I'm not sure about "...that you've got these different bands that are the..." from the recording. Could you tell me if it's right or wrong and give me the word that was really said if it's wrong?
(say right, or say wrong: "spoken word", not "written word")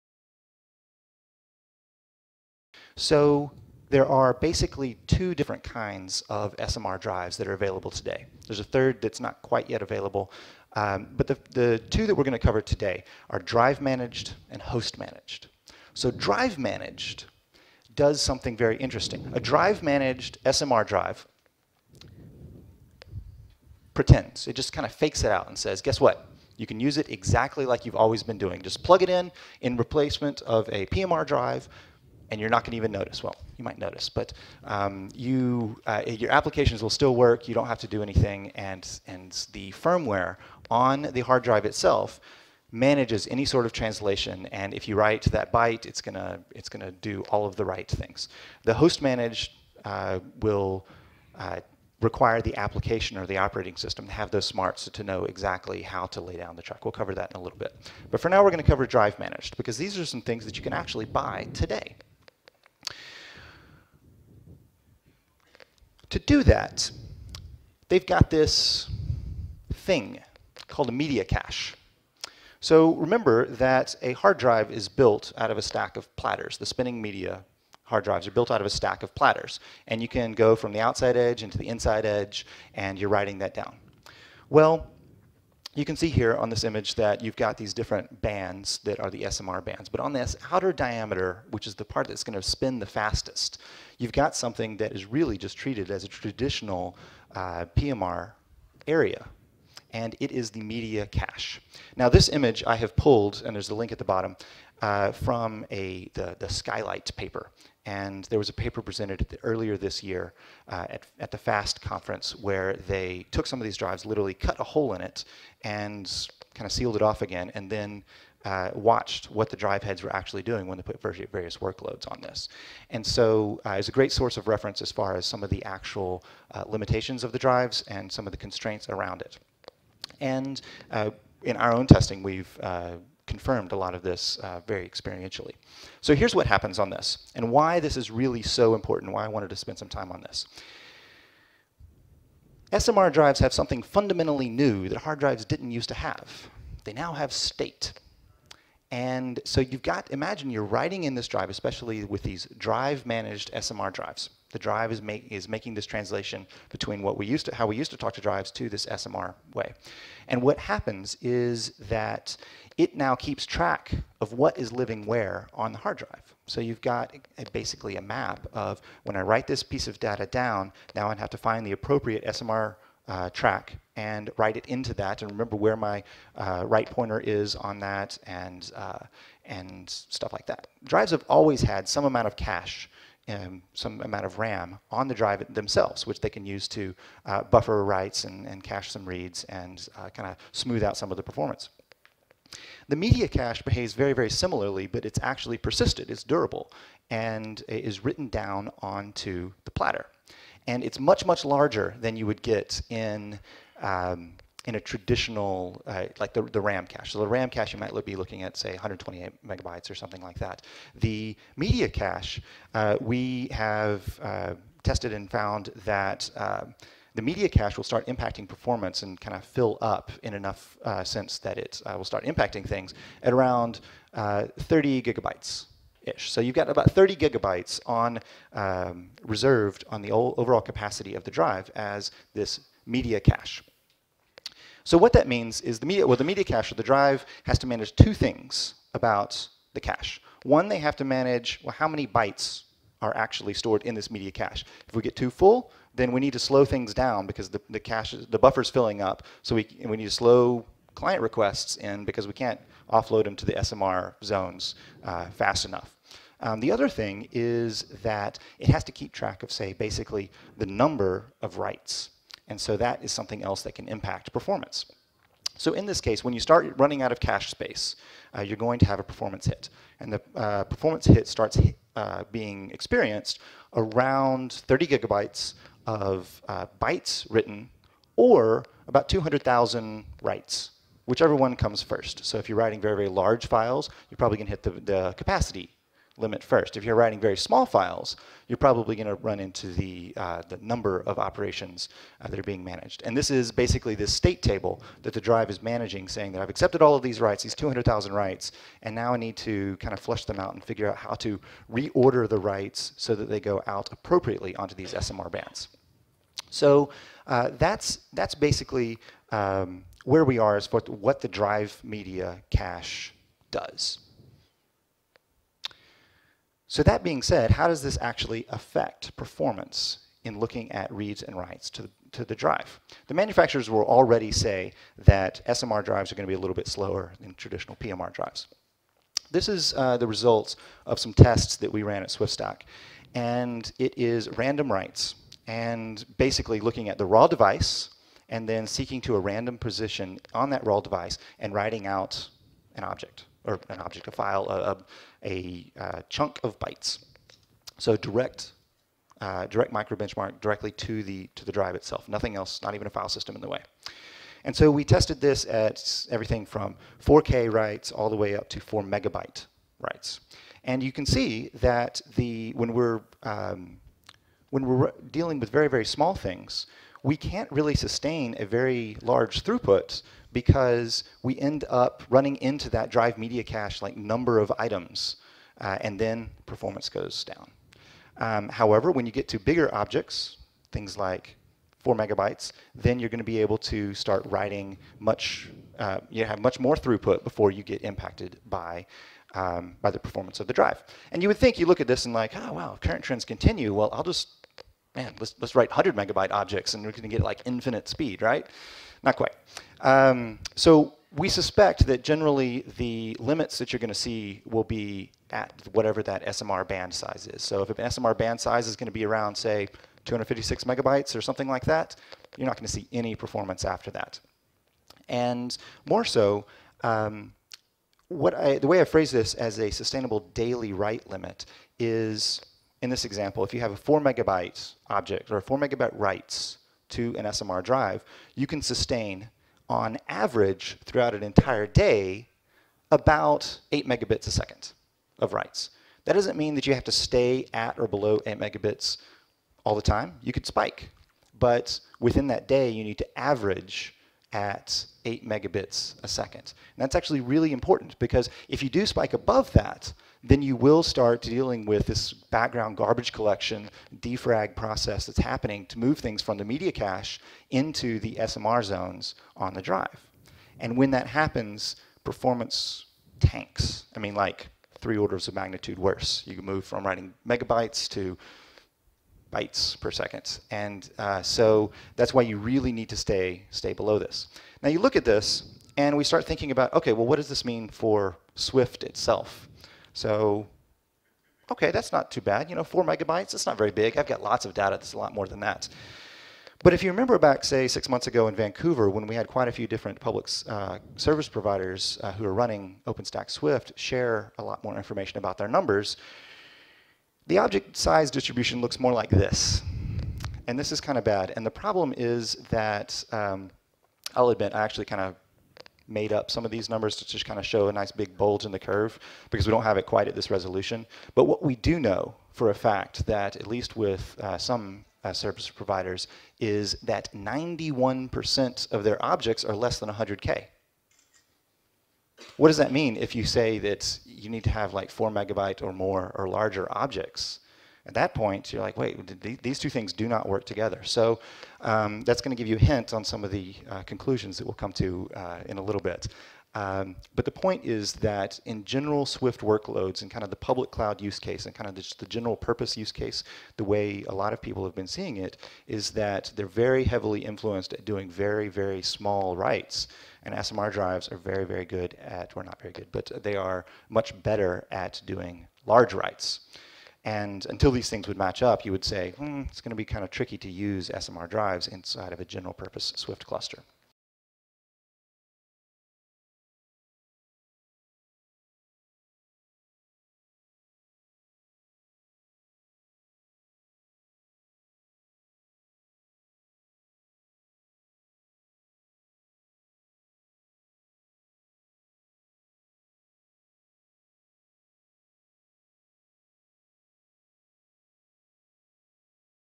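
right.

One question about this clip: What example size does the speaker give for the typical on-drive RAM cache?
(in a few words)
128 megabytes.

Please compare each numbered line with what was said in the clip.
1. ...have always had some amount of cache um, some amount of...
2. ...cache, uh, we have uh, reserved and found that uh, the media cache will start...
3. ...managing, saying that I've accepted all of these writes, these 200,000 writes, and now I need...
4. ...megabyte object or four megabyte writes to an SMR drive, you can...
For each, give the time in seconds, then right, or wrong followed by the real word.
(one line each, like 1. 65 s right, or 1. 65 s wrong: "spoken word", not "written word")
1. 181 s right
2. 211 s wrong: "tested", not "reserved"
3. 295 s right
4. 424 s right.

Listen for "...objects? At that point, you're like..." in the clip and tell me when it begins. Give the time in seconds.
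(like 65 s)
526 s.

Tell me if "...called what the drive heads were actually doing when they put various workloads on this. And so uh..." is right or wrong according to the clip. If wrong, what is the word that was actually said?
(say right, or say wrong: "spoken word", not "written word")
wrong: "watched", not "called".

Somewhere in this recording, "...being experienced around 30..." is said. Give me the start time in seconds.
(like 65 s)
272 s.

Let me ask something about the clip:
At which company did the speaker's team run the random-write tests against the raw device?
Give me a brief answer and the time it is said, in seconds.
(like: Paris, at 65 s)
SwiftStack, at 332 s.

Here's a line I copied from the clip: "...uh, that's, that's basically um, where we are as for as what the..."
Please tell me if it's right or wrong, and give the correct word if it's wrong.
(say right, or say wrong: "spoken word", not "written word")
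right.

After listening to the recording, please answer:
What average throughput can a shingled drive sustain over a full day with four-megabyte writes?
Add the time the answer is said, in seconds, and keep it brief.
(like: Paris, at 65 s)
8 megabits a second, at 433 s.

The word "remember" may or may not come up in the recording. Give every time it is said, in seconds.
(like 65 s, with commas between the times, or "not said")
72 s, 175 s, 486 s.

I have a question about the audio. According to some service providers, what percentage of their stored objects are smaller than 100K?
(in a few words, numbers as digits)
91%.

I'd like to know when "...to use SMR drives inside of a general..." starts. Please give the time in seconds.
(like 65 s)
560 s.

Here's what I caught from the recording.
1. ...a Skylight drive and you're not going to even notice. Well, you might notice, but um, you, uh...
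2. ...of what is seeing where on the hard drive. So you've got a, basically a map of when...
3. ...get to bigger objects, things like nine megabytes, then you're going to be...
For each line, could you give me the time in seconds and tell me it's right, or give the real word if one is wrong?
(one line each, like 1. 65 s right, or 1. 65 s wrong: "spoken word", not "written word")
1. 30 s wrong: "PMR", not "Skylight"
2. 164 s wrong: "living", not "seeing"
3. 379 s wrong: "four", not "nine".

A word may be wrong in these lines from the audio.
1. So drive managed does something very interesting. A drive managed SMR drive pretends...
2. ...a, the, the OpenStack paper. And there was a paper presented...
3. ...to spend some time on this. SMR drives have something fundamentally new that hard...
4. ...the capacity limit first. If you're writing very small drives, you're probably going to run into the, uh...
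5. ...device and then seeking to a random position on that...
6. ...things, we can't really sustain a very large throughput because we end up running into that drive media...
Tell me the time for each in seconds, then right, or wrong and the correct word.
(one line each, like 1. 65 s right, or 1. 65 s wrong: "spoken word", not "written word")
1. 15 s right
2. 105 s wrong: "Skylight", not "OpenStack"
3. 139 s right
4. 284 s wrong: "files", not "drives"
5. 337 s right
6. 366 s right.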